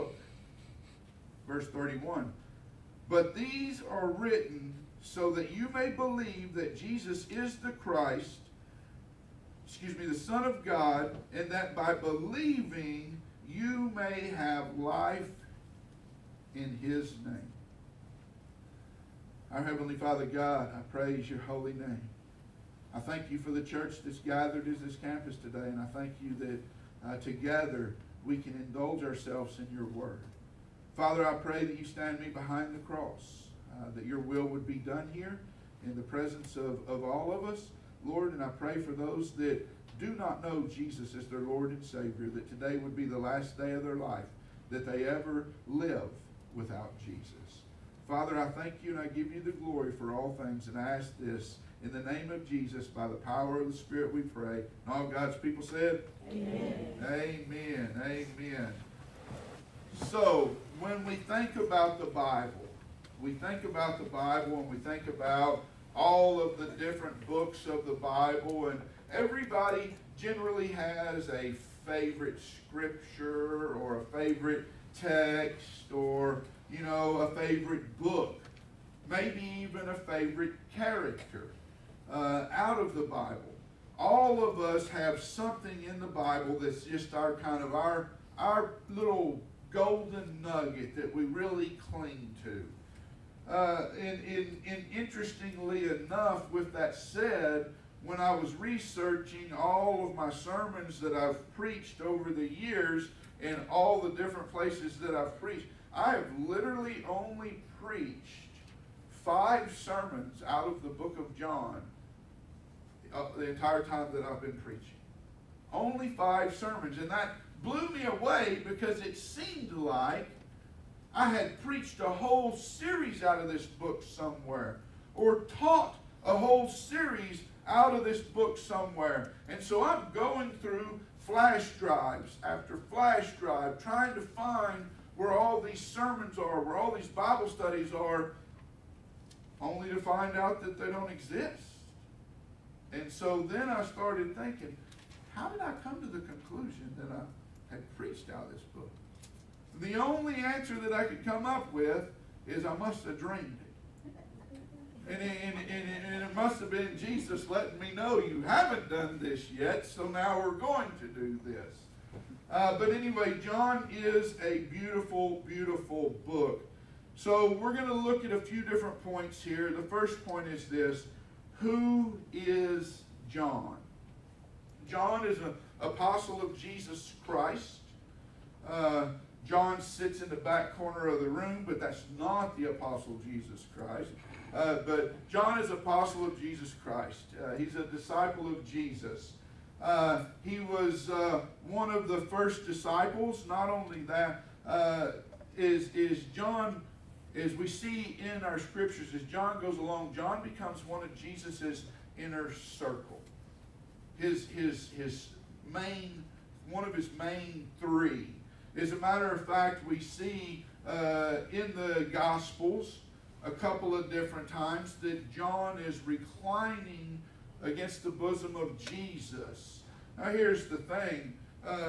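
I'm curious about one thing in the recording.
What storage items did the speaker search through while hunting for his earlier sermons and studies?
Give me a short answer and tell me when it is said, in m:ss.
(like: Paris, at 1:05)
Flash drives, at 2:11.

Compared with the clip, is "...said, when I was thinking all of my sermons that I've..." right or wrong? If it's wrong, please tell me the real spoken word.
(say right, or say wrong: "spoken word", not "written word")
wrong: "researching", not "thinking".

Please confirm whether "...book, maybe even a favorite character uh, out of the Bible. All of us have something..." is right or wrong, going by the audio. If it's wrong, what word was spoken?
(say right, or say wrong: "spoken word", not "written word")
right.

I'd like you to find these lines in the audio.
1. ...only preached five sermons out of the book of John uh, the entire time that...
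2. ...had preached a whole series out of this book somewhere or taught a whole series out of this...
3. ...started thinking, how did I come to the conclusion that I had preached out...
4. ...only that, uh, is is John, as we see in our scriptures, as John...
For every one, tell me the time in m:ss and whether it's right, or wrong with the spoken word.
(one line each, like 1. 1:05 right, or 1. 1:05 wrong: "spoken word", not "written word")
1. 1:47 right
2. 2:01 right
3. 2:23 right
4. 3:13 right.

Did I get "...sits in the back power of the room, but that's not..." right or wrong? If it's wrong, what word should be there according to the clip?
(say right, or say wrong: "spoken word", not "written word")
wrong: "corner", not "power".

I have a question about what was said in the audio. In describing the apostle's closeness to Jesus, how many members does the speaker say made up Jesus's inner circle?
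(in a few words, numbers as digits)
3.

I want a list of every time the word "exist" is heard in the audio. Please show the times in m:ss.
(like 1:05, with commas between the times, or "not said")
2:21.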